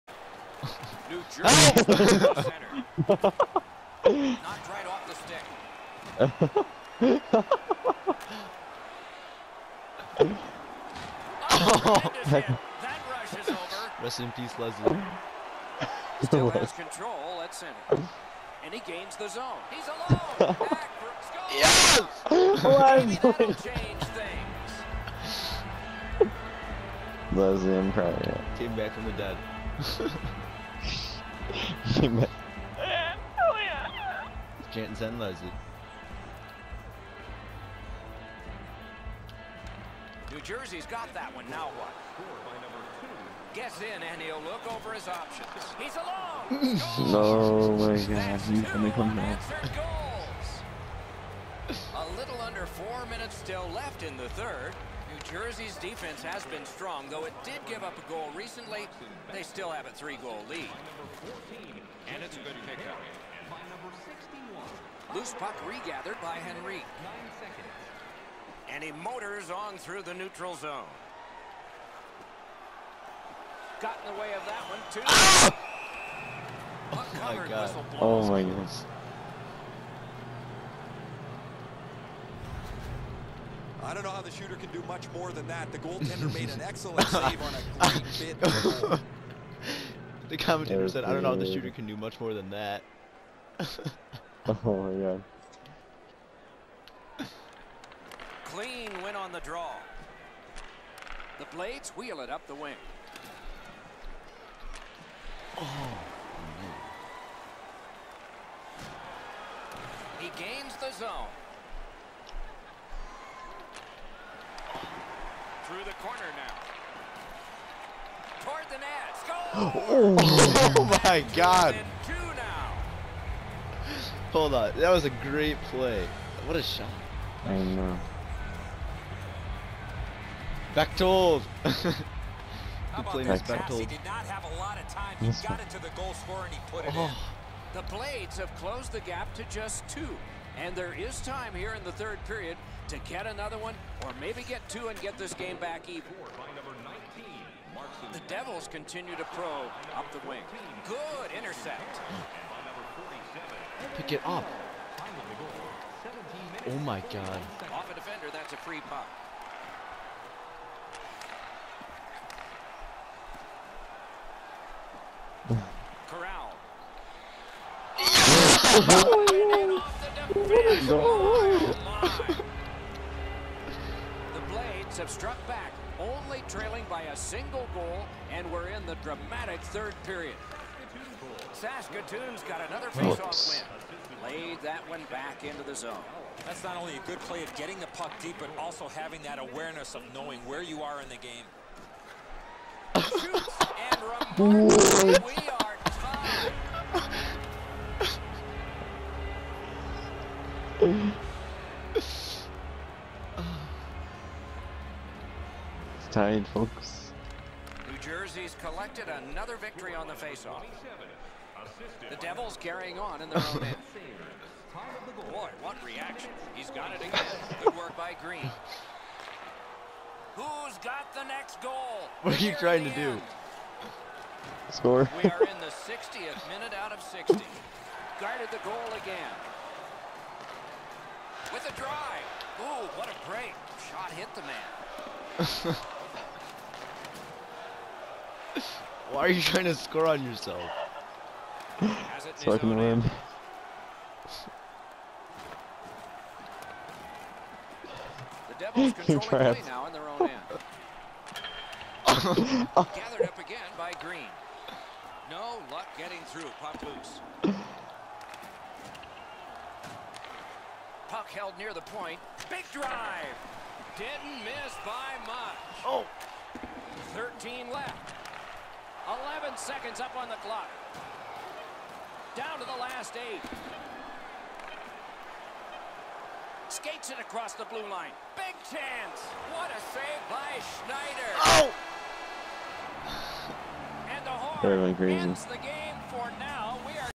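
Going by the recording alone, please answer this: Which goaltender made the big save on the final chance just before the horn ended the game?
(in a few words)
Schneider.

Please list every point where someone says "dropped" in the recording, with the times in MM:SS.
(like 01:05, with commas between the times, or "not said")
not said.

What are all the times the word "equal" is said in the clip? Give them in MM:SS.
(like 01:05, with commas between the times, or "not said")
not said.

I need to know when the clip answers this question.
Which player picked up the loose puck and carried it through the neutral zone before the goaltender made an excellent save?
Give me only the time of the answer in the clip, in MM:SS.
01:06.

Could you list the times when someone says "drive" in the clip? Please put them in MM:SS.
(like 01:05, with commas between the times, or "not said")
03:51, 04:22.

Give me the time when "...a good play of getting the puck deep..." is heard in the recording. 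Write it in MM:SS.
03:06.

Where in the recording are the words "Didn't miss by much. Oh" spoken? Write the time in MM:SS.
04:23.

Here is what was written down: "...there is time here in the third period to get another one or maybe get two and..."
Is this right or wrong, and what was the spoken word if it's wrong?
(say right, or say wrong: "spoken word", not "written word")
right.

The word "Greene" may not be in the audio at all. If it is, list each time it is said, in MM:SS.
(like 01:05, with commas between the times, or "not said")
03:38, 04:14.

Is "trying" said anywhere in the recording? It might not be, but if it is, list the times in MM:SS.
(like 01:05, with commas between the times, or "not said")
03:42, 03:59.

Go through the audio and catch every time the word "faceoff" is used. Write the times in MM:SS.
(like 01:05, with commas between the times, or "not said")
03:02, 03:30.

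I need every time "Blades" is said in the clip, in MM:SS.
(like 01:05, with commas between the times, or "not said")
01:41, 02:17.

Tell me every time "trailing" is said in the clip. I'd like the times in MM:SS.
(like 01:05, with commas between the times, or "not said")
02:56.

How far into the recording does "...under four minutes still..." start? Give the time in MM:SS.
00:52.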